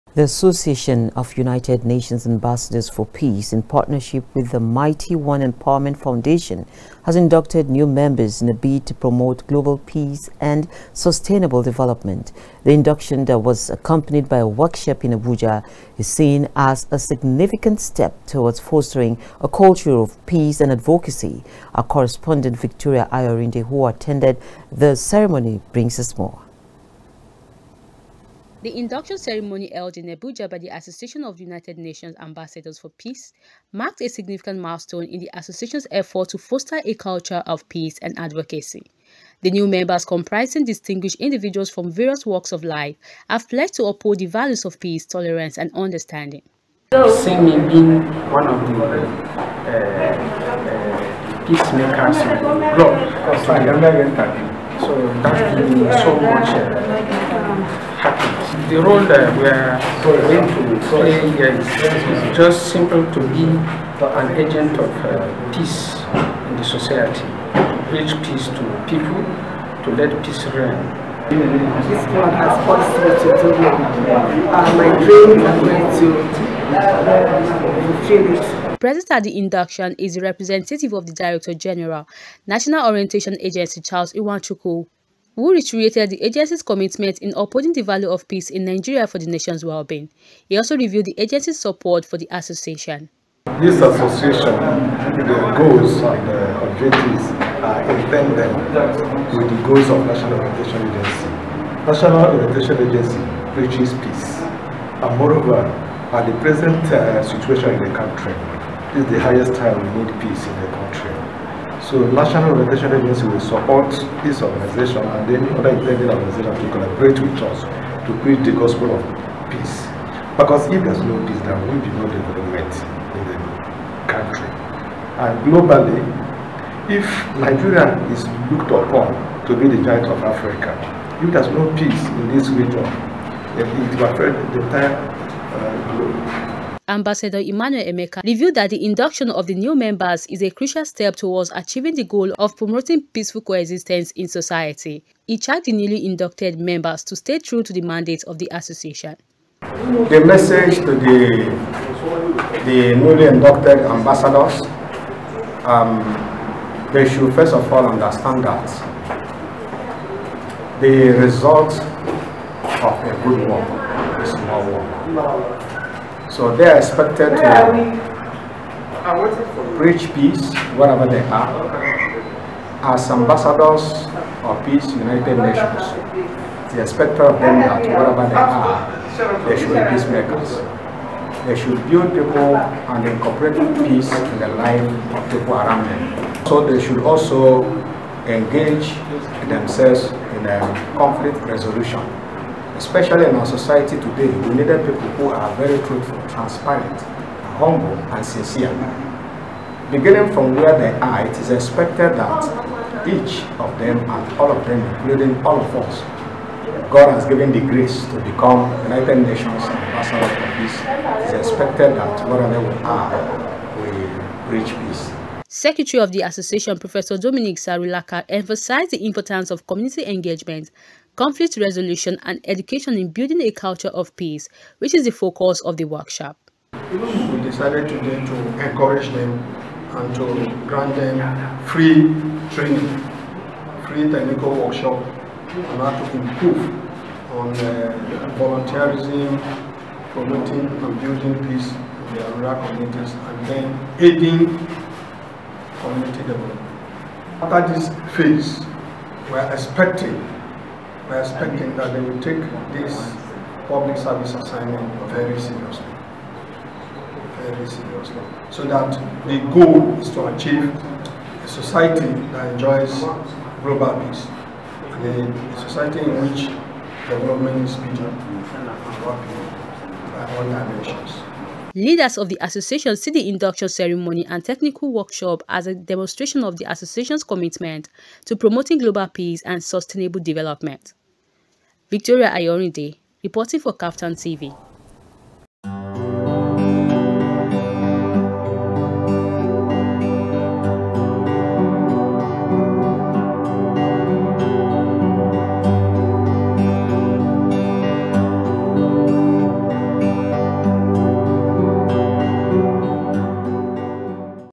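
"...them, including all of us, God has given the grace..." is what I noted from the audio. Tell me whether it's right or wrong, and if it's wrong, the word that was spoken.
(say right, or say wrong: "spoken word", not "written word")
right.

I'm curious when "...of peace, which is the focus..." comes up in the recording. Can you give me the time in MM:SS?
03:43.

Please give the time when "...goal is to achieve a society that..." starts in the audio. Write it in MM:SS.
04:19.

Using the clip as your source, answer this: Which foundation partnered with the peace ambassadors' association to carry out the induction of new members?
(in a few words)
Mighty One Empowerment Foundation.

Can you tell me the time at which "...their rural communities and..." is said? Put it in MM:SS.
04:02.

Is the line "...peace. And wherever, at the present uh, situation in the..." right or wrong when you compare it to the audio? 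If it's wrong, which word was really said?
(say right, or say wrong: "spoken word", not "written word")
wrong: "moreover", not "wherever".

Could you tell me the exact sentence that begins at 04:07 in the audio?
After this phase, we are expecting we are expecting that they will take this public service assignment very seriously.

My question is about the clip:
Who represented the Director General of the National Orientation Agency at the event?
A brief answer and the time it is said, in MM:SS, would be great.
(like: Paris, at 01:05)
Charles Iwanchukwu, at 01:23.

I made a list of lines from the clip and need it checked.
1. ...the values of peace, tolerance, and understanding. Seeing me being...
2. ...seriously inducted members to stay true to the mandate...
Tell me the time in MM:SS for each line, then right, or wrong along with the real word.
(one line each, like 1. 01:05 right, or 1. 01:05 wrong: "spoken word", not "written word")
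1. 00:44 right
2. 02:25 wrong: "newly", not "seriously".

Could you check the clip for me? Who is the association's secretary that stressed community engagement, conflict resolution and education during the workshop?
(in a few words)
Dominic Sarulaka.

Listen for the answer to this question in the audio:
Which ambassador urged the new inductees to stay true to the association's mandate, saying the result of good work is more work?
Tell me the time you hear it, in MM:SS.
02:17.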